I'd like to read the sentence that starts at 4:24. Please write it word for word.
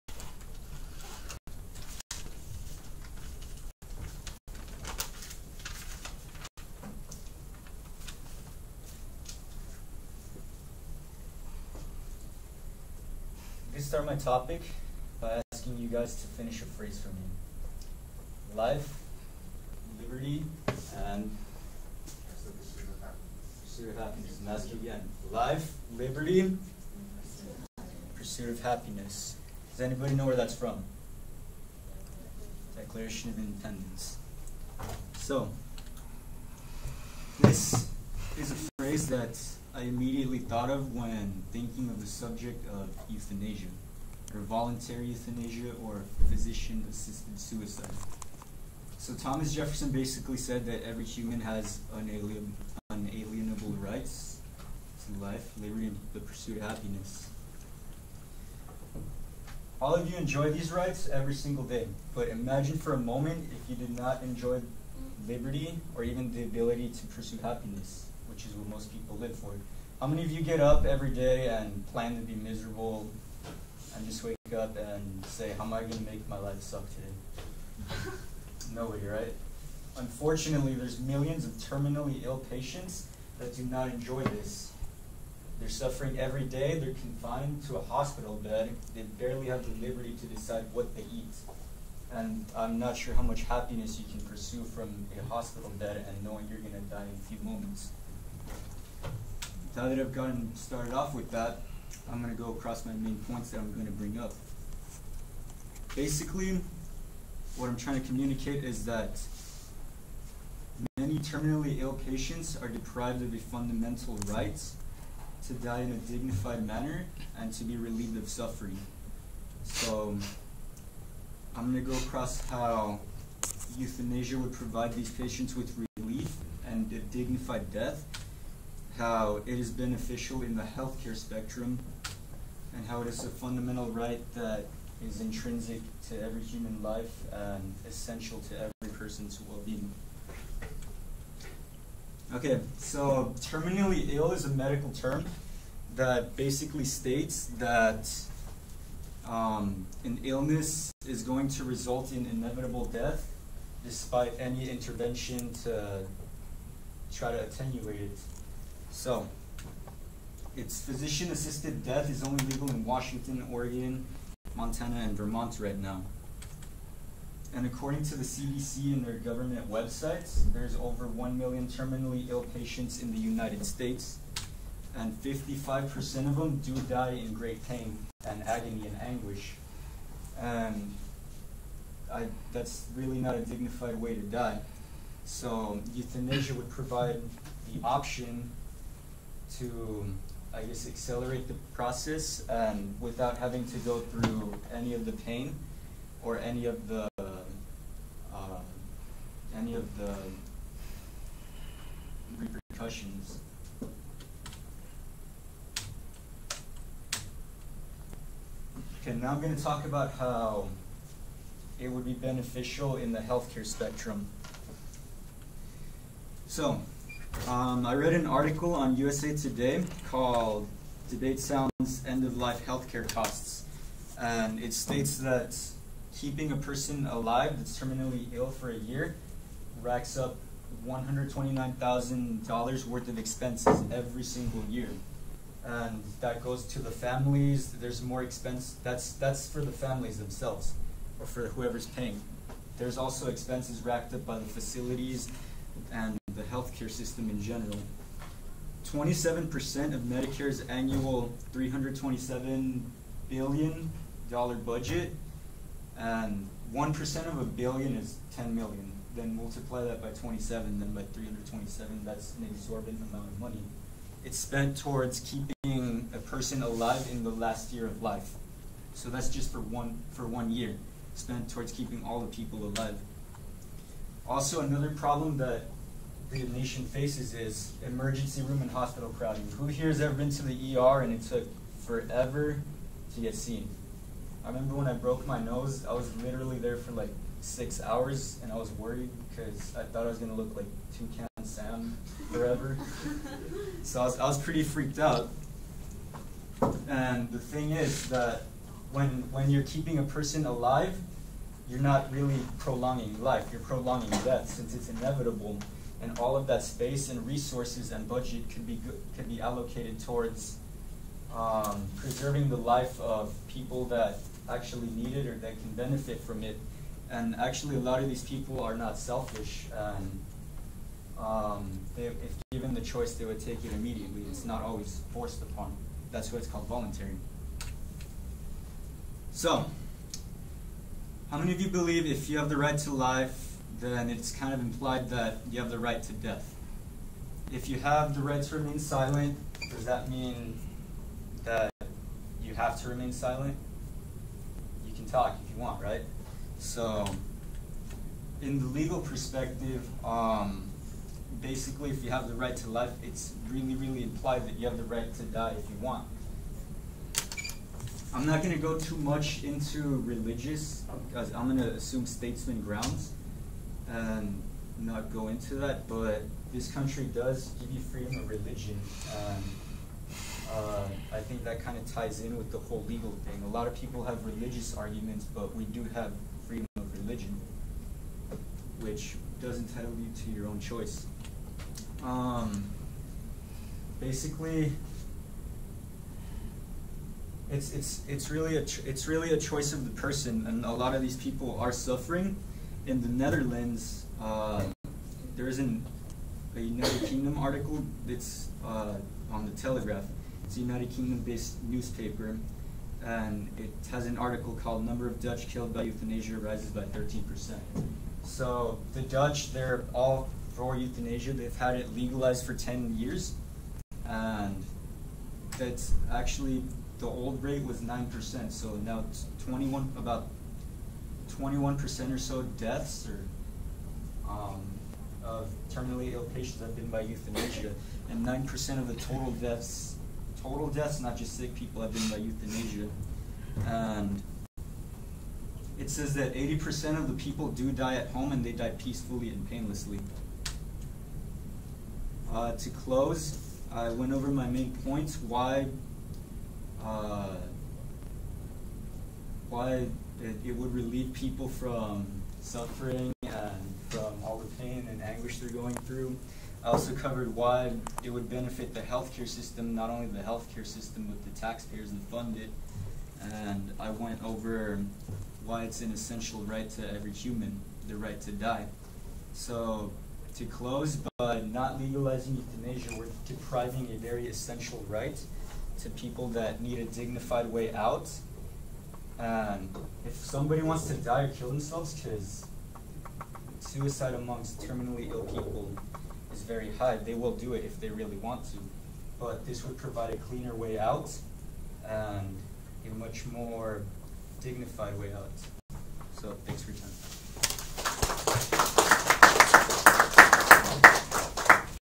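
It's spent towards keeping a person alive in the last year of life.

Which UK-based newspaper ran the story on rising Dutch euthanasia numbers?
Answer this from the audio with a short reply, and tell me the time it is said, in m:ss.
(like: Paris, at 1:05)
The Telegraph, at 6:39.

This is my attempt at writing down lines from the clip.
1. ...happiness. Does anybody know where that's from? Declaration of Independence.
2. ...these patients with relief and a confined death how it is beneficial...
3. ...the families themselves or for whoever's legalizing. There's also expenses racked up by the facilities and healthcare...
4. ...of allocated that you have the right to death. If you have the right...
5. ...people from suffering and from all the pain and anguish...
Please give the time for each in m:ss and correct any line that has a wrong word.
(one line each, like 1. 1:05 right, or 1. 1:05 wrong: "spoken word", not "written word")
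1. 0:28 right
2. 2:04 wrong: "dignified", not "confined"
3. 3:59 wrong: "paying", not "legalizing"
4. 5:34 wrong: "implied", not "allocated"
5. 7:31 right.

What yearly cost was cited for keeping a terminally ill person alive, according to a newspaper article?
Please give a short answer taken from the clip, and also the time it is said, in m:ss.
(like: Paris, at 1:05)
$129,000, at 3:50.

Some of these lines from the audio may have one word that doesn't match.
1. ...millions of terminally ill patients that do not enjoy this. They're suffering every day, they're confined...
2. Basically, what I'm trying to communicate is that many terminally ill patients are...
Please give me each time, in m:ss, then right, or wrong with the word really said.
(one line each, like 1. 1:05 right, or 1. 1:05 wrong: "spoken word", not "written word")
1. 1:20 right
2. 1:45 right.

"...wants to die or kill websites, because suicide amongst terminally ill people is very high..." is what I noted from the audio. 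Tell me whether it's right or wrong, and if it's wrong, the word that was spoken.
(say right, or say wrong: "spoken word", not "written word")
wrong: "themselves", not "websites".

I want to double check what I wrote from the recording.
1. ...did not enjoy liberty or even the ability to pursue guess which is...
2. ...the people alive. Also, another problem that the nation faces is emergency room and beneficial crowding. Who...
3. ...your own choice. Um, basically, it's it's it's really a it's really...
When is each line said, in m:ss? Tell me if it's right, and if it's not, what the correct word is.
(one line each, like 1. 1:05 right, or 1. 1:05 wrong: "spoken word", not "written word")
1. 1:03 wrong: "happiness", not "guess"
2. 4:32 wrong: "hospital", not "beneficial"
3. 6:20 right.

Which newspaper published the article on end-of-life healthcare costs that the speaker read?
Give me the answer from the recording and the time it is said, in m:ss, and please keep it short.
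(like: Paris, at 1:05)
USA Today, at 3:38.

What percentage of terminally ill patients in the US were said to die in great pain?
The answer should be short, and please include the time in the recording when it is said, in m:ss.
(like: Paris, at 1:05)
55%, at 2:55.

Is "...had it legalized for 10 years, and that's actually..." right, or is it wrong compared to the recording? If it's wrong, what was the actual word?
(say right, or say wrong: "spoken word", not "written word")
right.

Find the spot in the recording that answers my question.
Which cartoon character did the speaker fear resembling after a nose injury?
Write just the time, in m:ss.
4:50.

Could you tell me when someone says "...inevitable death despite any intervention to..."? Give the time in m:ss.
2:32.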